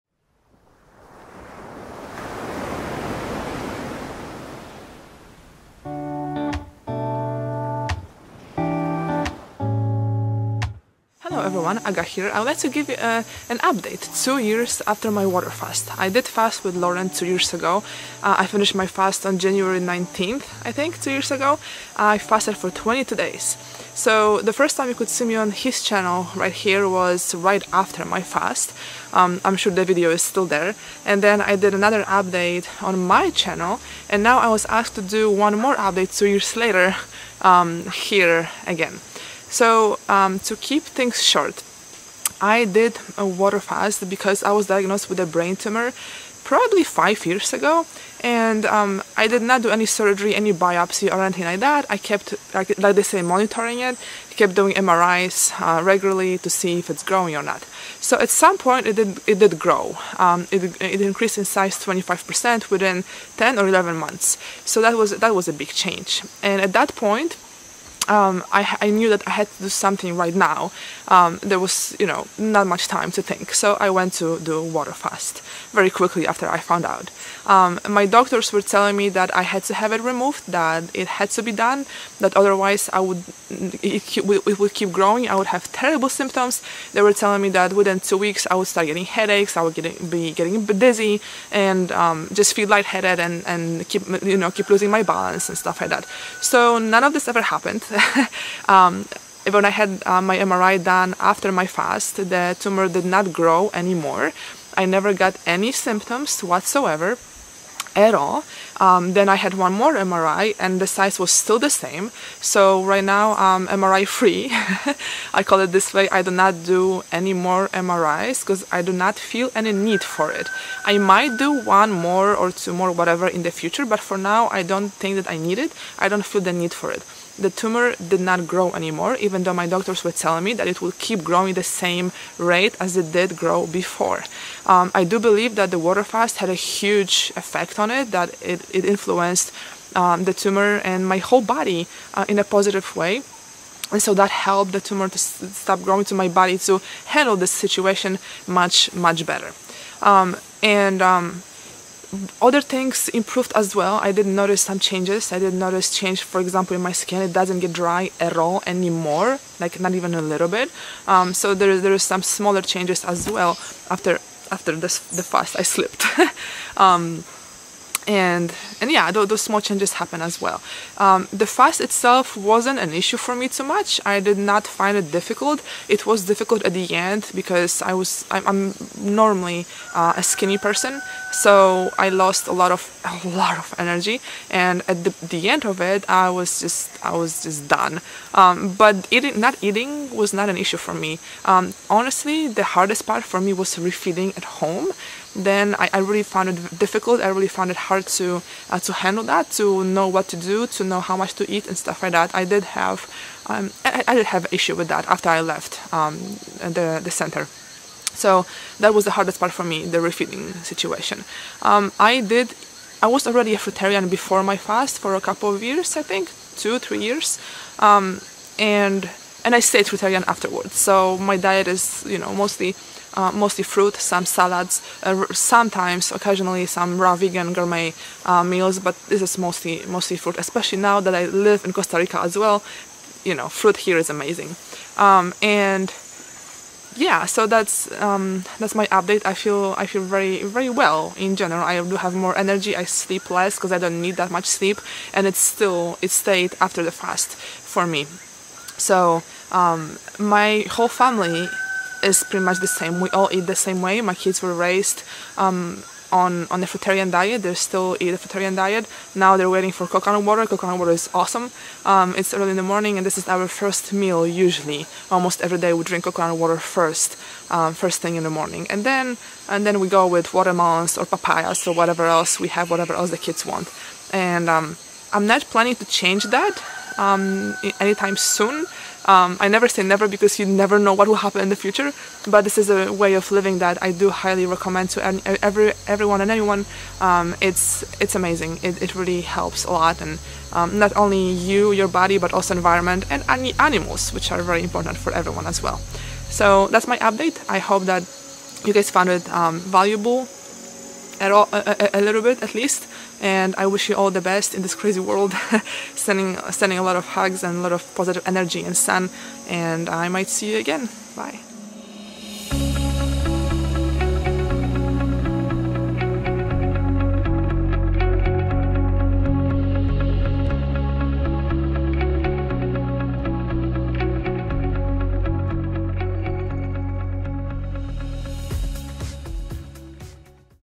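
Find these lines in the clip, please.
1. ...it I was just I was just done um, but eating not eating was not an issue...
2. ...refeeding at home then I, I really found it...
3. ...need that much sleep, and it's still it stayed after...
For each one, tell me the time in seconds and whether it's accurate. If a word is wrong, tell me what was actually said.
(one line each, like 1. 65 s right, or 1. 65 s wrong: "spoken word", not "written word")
1. 185 s right
2. 193 s right
3. 244 s right.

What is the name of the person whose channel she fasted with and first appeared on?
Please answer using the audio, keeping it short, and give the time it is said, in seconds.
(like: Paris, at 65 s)
Loren, at 16 s.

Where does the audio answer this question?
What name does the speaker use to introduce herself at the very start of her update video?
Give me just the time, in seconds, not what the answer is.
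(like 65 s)
11 s.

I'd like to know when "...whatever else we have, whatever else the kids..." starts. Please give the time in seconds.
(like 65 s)
271 s.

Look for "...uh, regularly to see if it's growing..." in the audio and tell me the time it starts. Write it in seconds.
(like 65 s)
55 s.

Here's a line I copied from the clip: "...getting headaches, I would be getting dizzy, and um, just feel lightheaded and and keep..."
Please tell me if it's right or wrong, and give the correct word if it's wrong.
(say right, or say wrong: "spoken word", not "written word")
right.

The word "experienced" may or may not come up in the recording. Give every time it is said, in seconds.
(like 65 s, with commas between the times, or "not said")
not said.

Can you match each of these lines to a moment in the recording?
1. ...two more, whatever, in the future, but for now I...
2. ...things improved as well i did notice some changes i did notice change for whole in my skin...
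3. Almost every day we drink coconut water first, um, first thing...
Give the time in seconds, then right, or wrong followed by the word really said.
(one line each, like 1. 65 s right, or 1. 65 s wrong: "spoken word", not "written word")
1. 122 s right
2. 152 s wrong: "example", not "whole"
3. 265 s right.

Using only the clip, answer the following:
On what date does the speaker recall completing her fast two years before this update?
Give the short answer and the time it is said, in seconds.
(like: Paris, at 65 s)
January 19th, at 19 s.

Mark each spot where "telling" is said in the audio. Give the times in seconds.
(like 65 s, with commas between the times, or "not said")
78 s, 87 s, 130 s.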